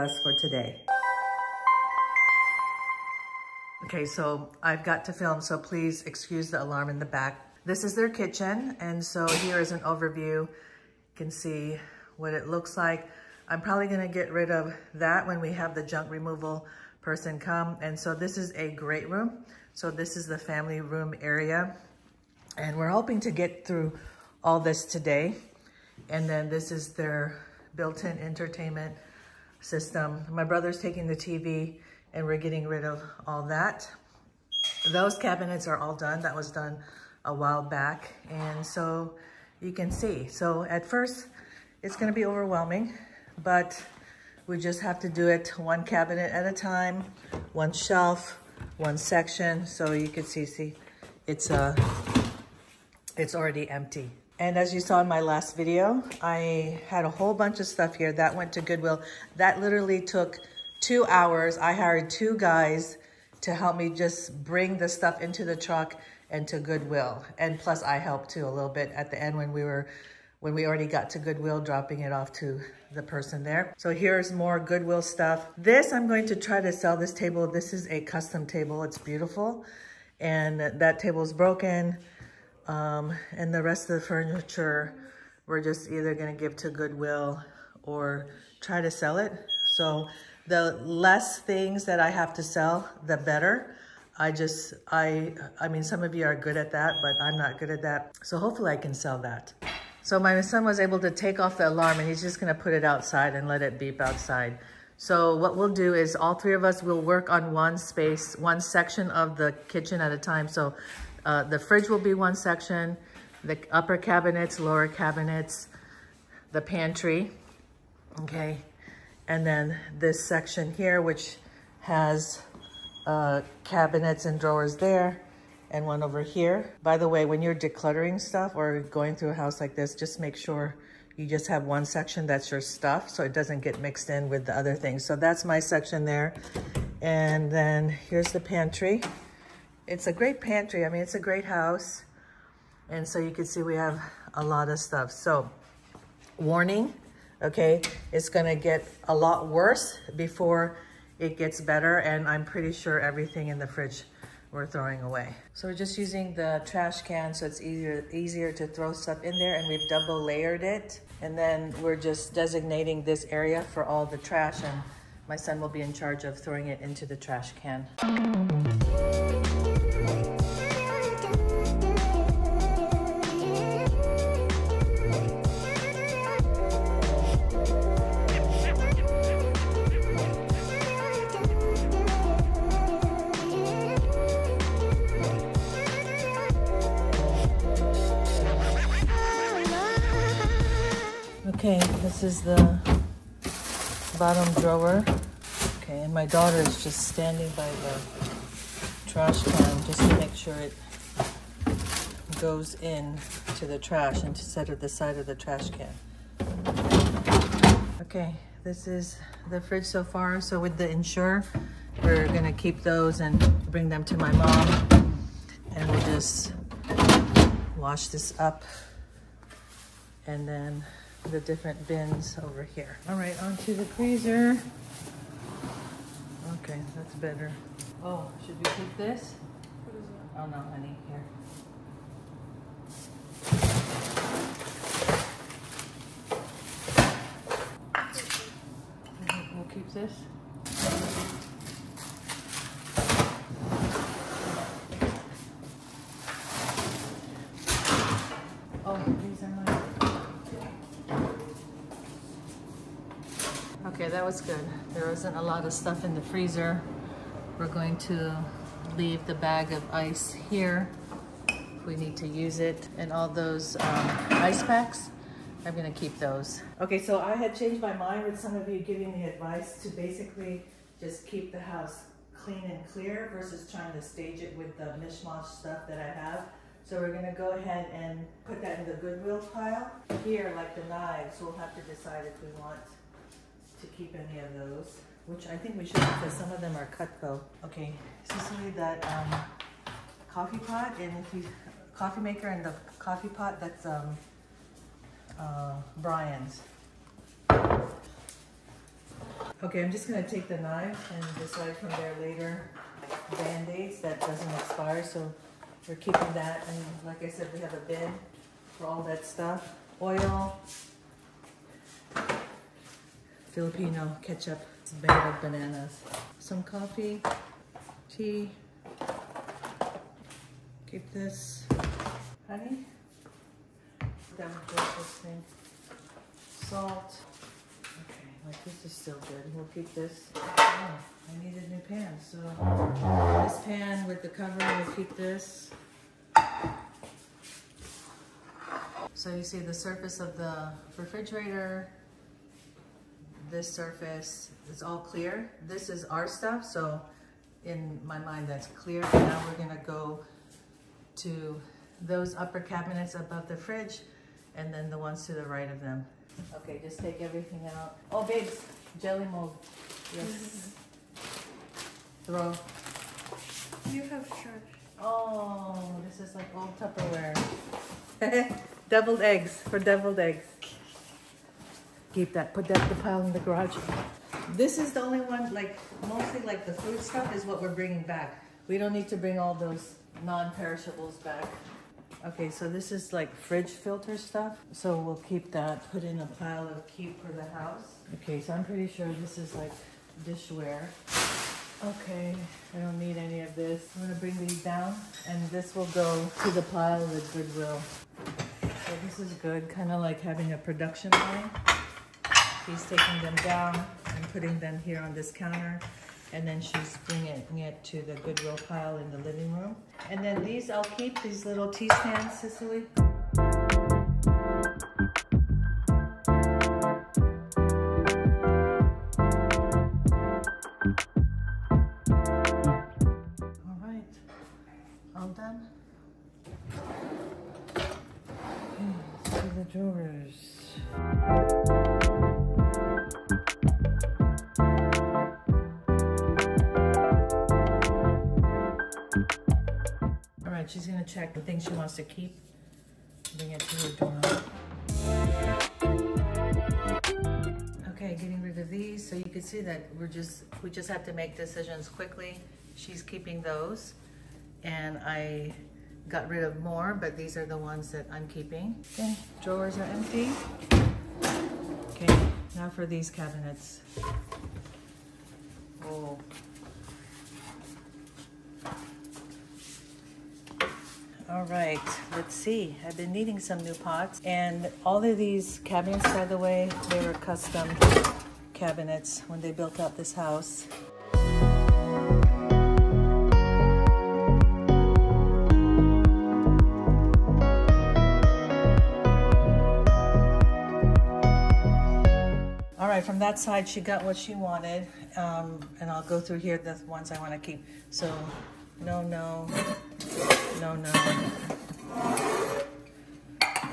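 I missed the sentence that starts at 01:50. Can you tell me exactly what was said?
So uh, the fridge will be one section, the upper cabinets, lower cabinets, the pantry, okay?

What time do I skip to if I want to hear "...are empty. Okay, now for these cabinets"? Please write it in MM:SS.
07:39.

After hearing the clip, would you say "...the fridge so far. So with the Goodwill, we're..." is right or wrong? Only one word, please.
wrong.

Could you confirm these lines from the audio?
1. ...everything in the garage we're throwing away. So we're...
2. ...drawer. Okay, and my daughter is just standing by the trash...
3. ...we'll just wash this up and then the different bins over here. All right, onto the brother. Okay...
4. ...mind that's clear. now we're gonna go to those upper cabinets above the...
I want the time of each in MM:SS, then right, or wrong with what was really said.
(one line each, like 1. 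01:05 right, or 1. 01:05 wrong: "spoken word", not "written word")
1. 02:32 wrong: "fridge", not "garage"
2. 03:14 right
3. 03:35 wrong: "freezer", not "brother"
4. 05:48 right.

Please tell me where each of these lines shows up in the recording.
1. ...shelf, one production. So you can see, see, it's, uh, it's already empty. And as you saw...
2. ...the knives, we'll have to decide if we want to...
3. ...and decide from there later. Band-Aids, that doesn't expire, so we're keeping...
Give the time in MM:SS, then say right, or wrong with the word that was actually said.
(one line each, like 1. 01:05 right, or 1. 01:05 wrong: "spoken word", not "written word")
1. 00:47 wrong: "section", not "production"
2. 04:40 right
3. 05:01 right.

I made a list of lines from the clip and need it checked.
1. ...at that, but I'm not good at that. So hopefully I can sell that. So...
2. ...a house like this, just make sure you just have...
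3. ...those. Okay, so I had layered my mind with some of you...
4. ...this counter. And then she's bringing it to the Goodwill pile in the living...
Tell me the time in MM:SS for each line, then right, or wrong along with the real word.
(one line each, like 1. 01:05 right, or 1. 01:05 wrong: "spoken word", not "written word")
1. 01:36 right
2. 02:09 right
3. 04:26 wrong: "changed", not "layered"
4. 06:45 right.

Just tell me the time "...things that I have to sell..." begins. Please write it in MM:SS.
01:31.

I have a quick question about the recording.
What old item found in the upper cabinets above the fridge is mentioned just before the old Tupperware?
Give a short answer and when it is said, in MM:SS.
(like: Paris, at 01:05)
Jelly mold, at 05:59.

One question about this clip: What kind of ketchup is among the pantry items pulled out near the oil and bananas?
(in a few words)
Filipino ketchup.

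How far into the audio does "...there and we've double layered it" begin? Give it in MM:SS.
02:39.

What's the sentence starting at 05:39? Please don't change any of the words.
So you see the surface of the refrigerator, this surface is all clear.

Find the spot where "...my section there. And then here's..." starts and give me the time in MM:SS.
02:15.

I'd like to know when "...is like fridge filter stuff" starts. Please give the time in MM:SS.
06:22.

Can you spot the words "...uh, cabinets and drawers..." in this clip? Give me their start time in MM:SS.
02:03.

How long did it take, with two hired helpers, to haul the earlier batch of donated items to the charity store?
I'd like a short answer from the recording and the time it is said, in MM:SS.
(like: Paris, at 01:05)
2 hours, at 01:00.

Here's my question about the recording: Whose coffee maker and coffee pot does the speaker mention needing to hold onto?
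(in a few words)
Brian's.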